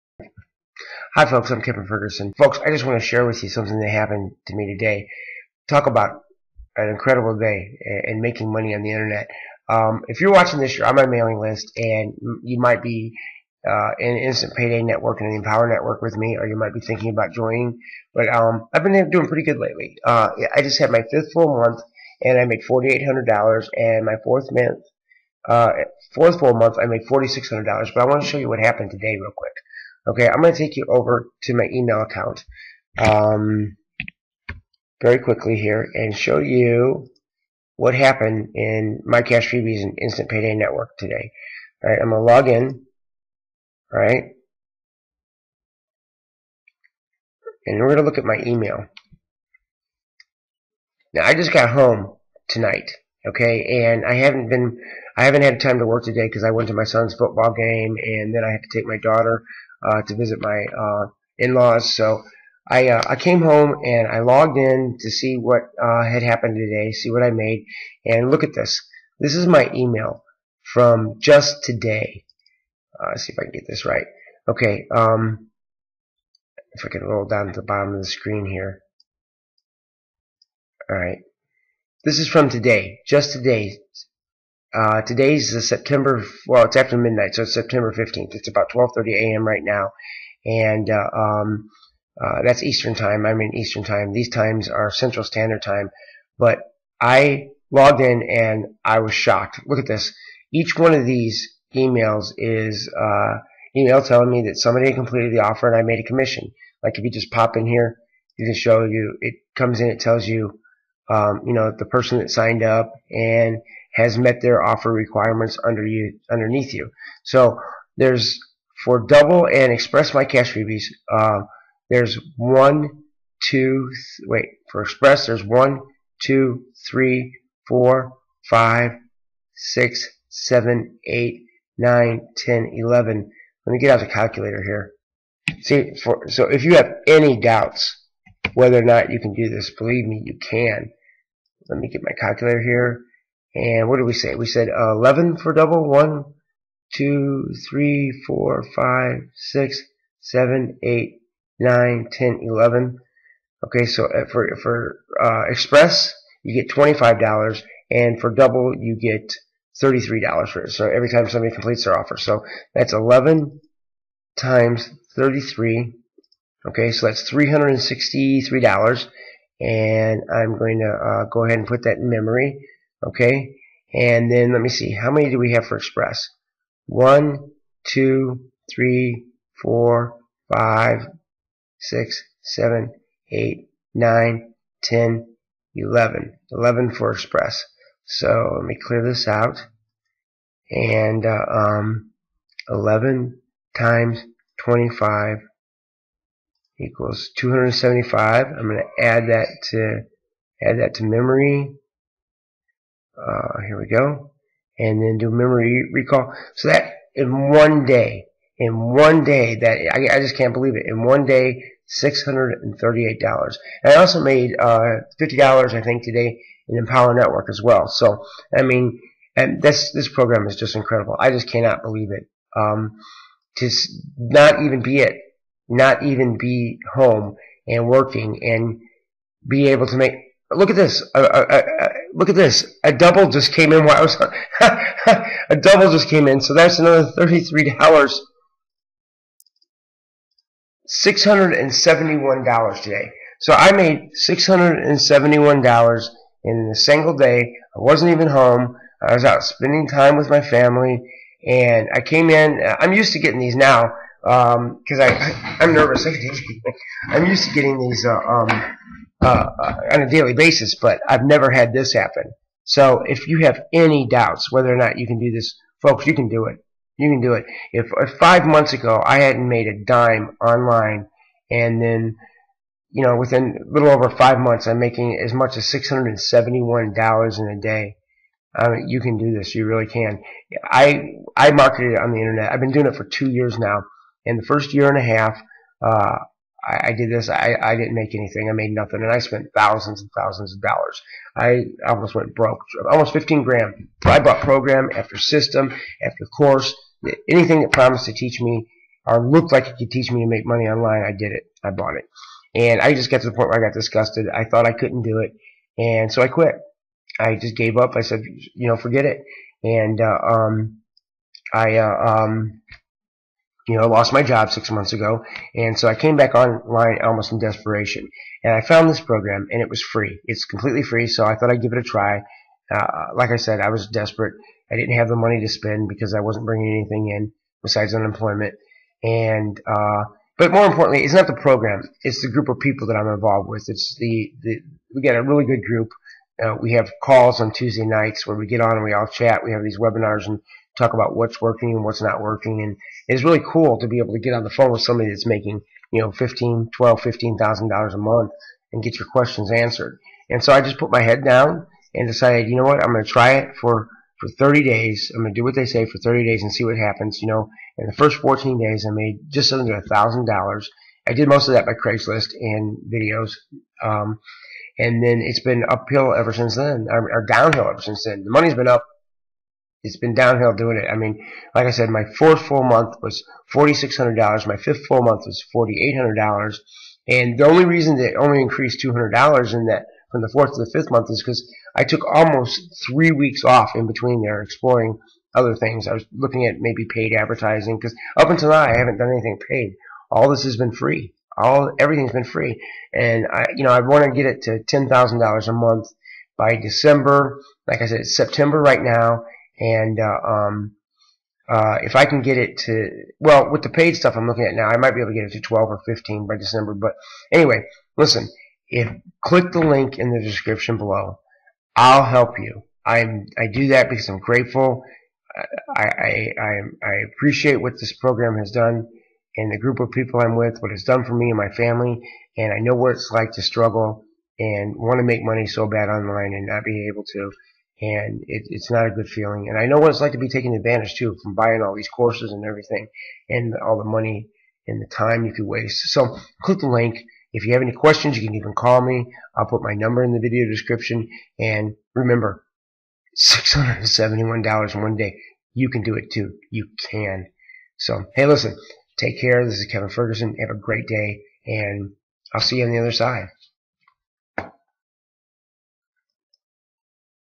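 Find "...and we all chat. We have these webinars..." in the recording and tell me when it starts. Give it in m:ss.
5:38.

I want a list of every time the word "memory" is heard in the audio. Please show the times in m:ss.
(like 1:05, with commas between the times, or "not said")
2:52, 3:21, 3:25.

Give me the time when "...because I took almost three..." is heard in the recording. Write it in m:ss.
6:21.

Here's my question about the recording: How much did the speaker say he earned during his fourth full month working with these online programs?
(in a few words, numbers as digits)
$4,600.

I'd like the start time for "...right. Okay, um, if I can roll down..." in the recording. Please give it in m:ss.
1:13.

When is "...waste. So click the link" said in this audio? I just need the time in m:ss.
7:15.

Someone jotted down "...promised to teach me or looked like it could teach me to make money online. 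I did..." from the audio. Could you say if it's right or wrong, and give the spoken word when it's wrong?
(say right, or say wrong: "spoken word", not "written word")
right.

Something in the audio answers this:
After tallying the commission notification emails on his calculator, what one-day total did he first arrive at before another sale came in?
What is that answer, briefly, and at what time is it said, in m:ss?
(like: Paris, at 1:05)
$638, at 3:31.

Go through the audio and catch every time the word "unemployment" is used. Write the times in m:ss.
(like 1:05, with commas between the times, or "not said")
5:27.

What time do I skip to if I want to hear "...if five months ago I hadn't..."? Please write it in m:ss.
4:27.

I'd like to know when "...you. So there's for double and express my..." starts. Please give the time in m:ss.
1:56.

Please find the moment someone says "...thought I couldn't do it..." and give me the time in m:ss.
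5:04.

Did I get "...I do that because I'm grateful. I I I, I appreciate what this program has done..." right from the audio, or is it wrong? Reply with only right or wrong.
right.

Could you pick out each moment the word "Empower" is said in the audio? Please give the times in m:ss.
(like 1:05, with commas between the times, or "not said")
0:15, 3:36.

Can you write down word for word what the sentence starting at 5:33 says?
It's the, the we got a really good group.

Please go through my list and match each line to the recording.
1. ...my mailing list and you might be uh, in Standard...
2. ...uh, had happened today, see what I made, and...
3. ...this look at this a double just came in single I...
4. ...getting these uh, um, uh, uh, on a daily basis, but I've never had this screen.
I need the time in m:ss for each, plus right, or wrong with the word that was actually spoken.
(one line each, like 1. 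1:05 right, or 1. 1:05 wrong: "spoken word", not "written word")
1. 0:10 wrong: "Instant", not "Standard"
2. 1:05 right
3. 3:50 wrong: "while", not "single"
4. 4:17 wrong: "happen", not "screen".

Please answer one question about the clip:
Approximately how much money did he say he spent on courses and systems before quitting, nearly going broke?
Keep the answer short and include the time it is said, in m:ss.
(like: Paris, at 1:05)
almost 15 grand, at 4:52.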